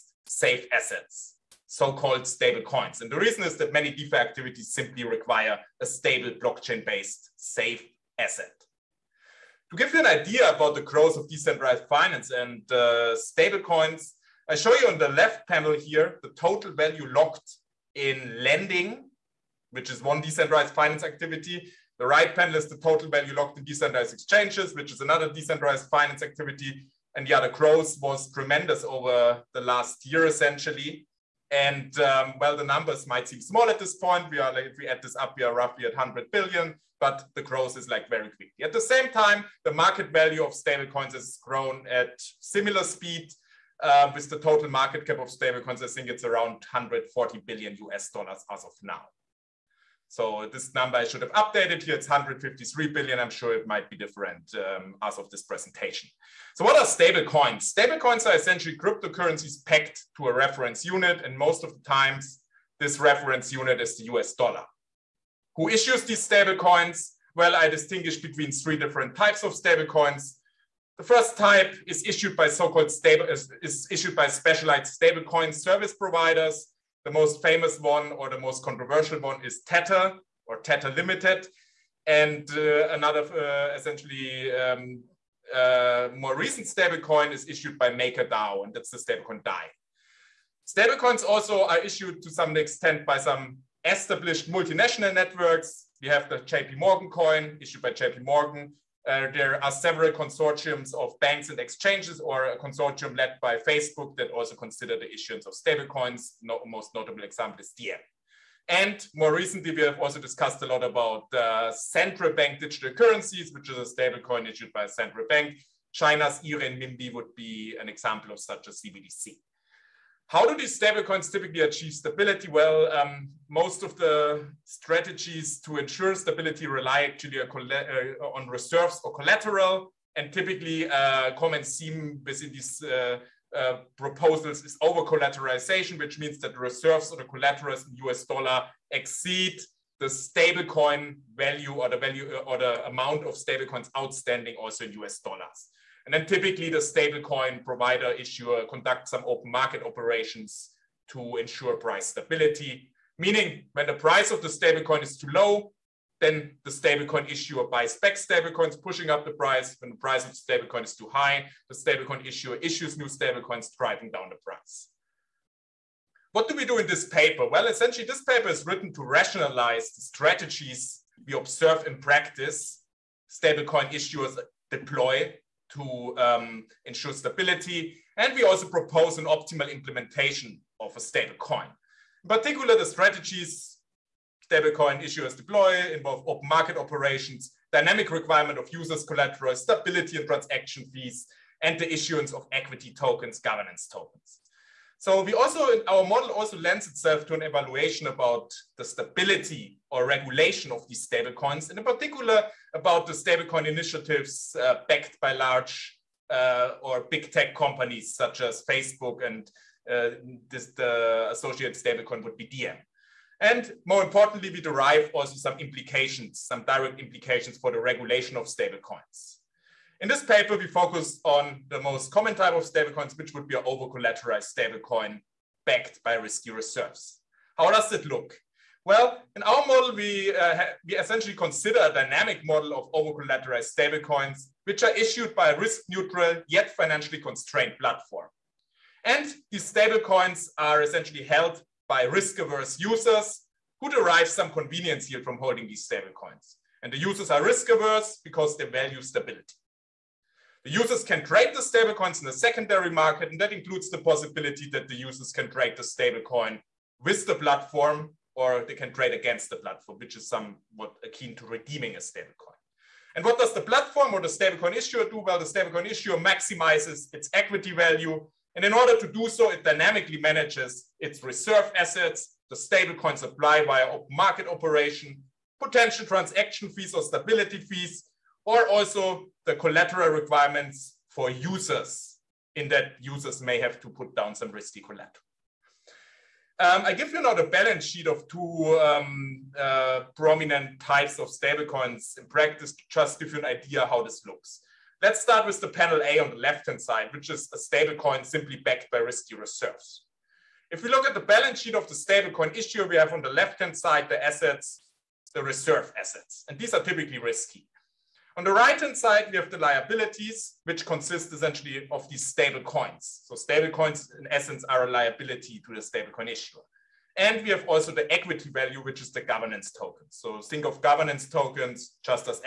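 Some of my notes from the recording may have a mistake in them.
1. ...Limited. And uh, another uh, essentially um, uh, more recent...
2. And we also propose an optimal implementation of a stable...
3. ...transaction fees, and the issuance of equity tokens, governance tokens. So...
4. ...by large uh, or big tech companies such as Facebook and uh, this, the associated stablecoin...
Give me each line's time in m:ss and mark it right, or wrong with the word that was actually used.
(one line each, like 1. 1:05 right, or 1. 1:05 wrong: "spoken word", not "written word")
1. 1:20 right
2. 2:58 right
3. 3:10 right
4. 3:25 right.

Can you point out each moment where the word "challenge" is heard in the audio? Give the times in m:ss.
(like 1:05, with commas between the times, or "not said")
not said.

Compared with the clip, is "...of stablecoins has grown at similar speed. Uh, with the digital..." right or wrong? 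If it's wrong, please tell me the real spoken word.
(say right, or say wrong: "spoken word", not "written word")
wrong: "total", not "digital".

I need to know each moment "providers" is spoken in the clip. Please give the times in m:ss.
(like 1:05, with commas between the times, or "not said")
1:15, 2:27.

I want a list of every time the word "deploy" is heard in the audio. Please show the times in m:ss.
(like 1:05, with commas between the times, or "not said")
2:54, 3:05.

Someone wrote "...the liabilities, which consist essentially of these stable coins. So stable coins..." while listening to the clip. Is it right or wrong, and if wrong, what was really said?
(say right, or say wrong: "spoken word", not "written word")
right.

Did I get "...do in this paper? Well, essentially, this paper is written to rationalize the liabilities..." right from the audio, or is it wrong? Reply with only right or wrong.
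wrong.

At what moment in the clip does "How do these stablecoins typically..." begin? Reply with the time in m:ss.
2:00.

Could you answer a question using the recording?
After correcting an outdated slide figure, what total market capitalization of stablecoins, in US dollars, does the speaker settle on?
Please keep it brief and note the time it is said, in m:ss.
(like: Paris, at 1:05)
153 billion, at 0:52.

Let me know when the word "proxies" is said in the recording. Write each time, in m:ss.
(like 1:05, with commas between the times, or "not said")
not said.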